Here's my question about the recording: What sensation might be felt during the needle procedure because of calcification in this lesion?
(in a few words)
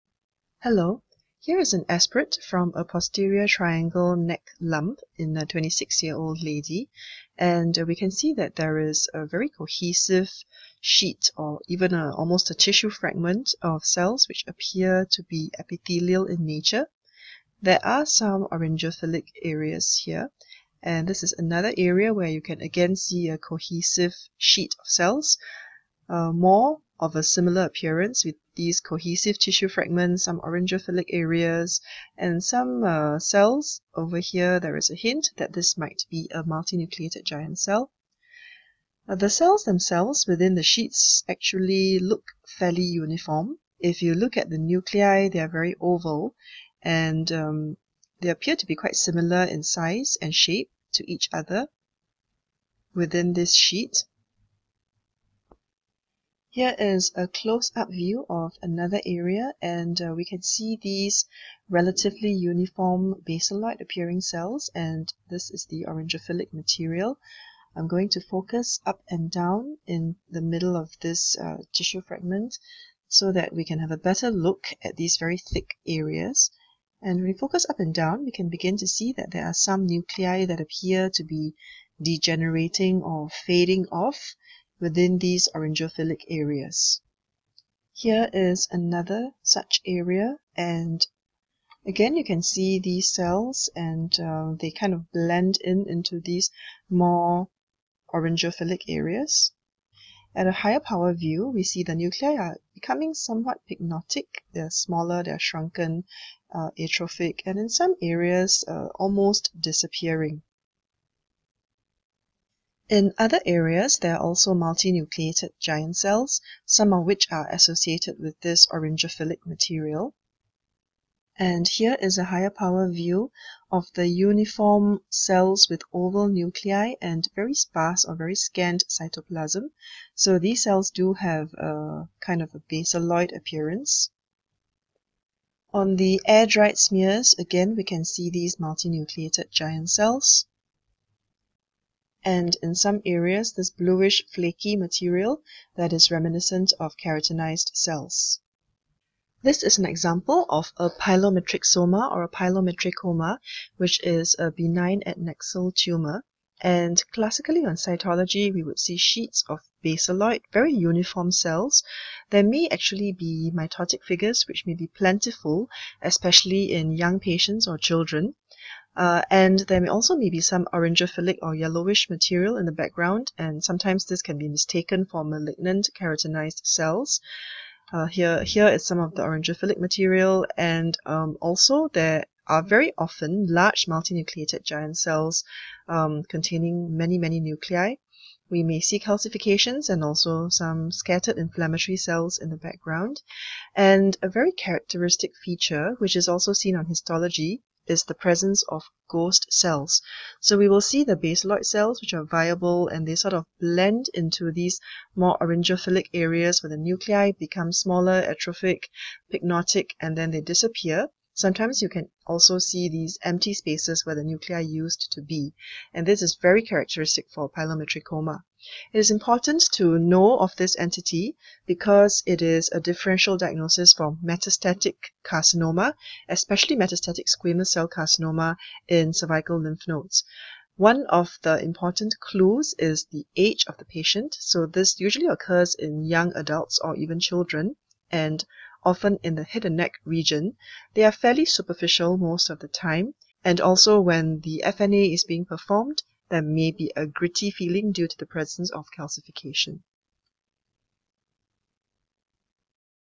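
A gritty feeling.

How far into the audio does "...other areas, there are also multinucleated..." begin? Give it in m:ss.
1:53.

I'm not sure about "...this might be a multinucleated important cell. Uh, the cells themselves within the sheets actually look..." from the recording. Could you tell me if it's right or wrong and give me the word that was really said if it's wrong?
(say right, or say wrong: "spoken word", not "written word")
wrong: "giant", not "important".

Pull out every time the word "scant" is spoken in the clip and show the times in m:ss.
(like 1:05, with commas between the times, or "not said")
2:08.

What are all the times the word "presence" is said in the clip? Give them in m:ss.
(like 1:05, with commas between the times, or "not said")
3:18, 4:08.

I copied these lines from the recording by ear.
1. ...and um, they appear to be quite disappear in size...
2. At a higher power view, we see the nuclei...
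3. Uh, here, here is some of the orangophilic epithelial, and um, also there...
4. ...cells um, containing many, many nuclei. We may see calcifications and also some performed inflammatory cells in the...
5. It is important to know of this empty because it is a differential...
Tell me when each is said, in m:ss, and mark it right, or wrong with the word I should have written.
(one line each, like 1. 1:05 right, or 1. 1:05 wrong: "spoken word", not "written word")
1. 0:46 wrong: "similar", not "disappear"
2. 1:40 right
3. 2:57 wrong: "material", not "epithelial"
4. 3:04 wrong: "scattered", not "performed"
5. 3:38 wrong: "entity", not "empty".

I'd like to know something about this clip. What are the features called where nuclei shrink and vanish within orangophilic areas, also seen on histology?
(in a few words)
Ghost cells.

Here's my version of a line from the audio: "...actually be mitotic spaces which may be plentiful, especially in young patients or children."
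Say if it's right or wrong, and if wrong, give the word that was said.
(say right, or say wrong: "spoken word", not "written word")
wrong: "figures", not "spaces".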